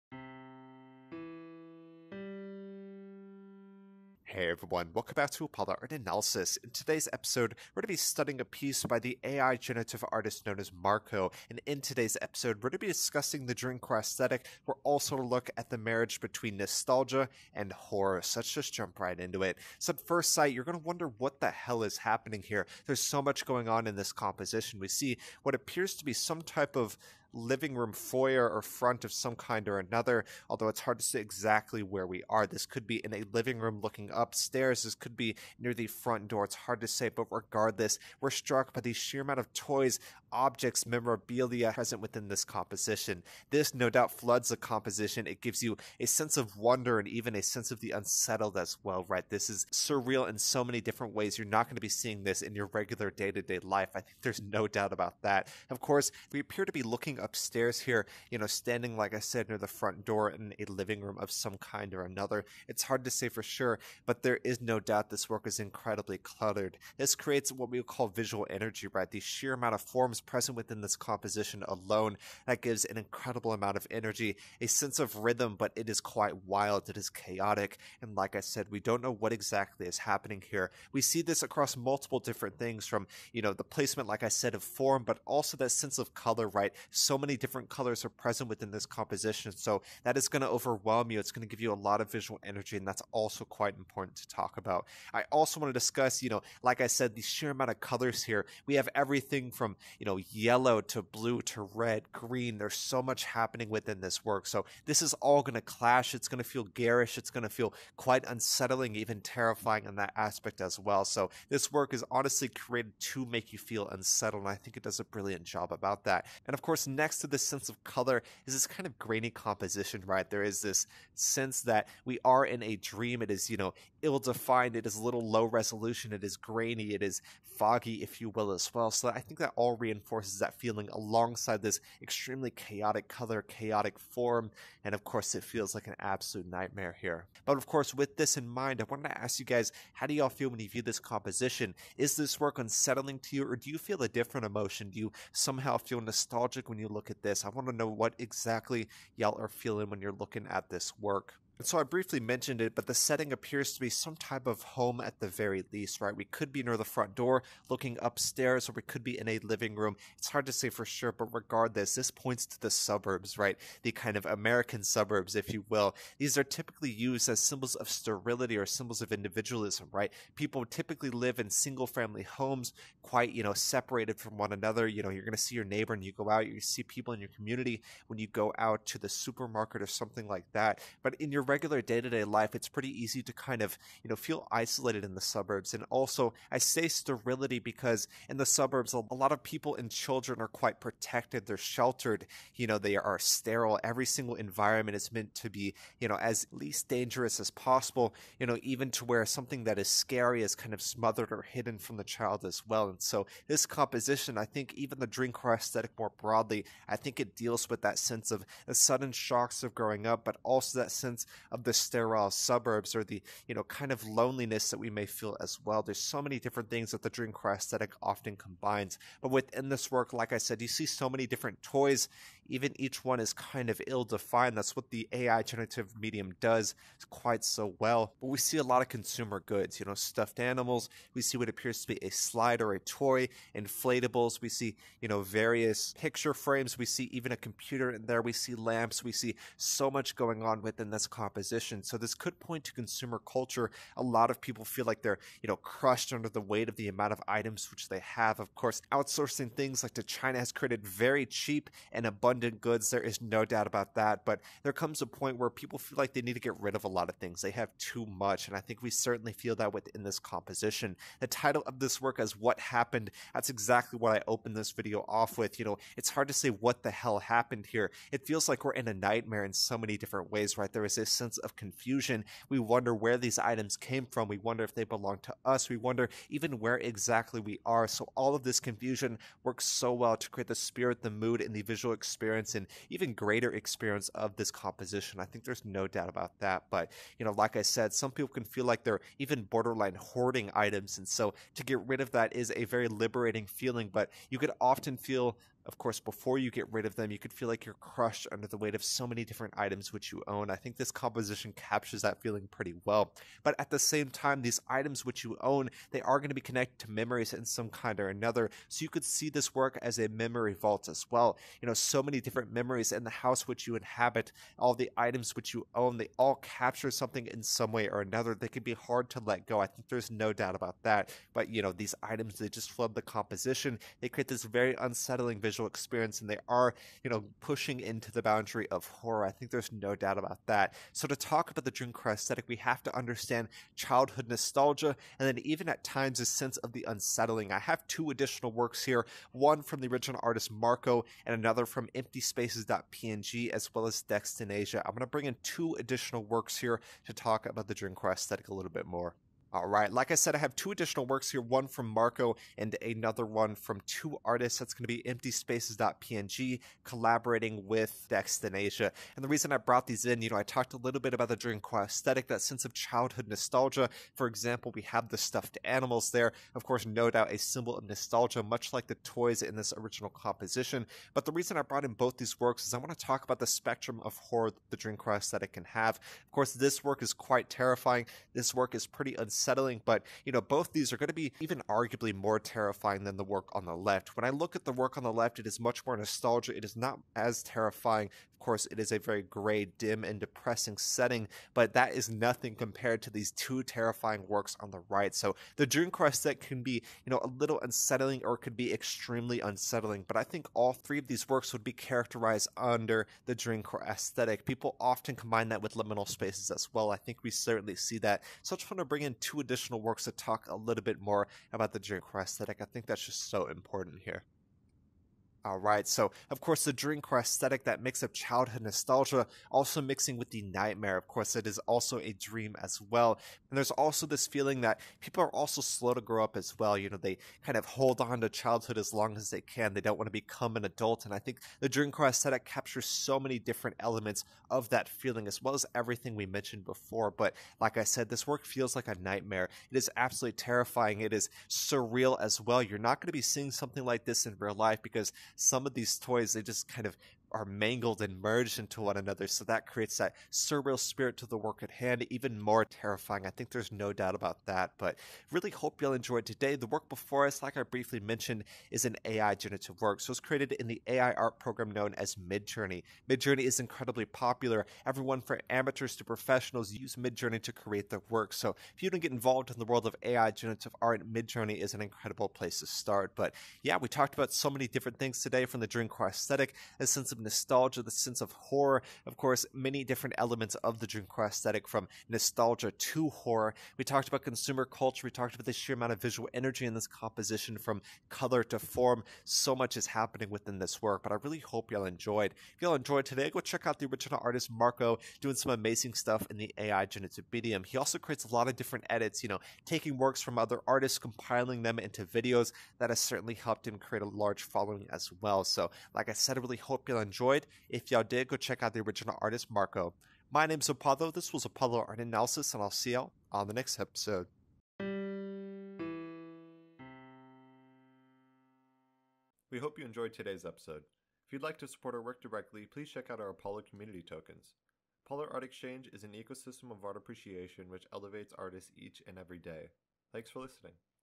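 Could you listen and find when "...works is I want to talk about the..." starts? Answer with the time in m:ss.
6:12.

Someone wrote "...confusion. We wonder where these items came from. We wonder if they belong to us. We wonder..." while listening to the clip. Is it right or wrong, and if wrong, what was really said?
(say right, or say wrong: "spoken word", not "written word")
right.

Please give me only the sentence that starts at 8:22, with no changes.
That has certainly helped him create a large following as well.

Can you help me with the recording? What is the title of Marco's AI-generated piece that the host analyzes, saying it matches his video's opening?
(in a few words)
What Happened.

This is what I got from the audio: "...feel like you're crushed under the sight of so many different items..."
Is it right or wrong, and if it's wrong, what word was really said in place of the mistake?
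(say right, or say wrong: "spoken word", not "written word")
wrong: "weight", not "sight".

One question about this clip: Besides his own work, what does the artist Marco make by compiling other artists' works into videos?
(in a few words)
edits.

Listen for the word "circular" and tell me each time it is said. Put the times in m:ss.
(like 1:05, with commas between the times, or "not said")
not said.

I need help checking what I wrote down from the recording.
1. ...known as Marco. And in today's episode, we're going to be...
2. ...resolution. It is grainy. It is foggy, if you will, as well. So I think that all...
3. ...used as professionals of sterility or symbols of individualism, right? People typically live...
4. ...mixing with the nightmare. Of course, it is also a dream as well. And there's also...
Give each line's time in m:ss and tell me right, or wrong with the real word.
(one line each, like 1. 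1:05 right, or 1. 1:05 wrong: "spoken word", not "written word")
1. 0:10 right
2. 2:05 right
3. 2:46 wrong: "symbols", not "professionals"
4. 6:59 right.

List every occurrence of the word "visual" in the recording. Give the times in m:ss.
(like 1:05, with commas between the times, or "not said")
1:08, 1:32, 4:41, 5:25, 8:06.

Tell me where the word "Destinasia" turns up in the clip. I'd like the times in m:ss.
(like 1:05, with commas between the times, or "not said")
5:44, 5:58.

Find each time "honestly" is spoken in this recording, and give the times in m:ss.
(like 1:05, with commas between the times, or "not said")
1:52.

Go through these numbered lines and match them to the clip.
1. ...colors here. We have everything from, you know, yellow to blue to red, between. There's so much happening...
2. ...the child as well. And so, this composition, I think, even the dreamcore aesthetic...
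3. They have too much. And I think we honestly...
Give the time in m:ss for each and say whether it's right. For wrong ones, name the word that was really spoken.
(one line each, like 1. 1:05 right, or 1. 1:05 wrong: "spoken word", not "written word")
1. 1:37 wrong: "green", not "between"
2. 3:21 right
3. 4:17 wrong: "certainly", not "honestly".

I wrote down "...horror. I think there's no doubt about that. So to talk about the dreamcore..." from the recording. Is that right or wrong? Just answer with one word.
right.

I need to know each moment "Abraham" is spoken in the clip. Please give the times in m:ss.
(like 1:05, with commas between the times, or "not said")
not said.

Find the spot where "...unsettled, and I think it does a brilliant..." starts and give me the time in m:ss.
1:53.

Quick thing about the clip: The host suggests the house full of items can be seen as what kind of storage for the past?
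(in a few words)
memory vault.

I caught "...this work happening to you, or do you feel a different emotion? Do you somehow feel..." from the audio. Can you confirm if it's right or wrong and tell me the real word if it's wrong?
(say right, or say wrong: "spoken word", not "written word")
wrong: "unsettling", not "happening".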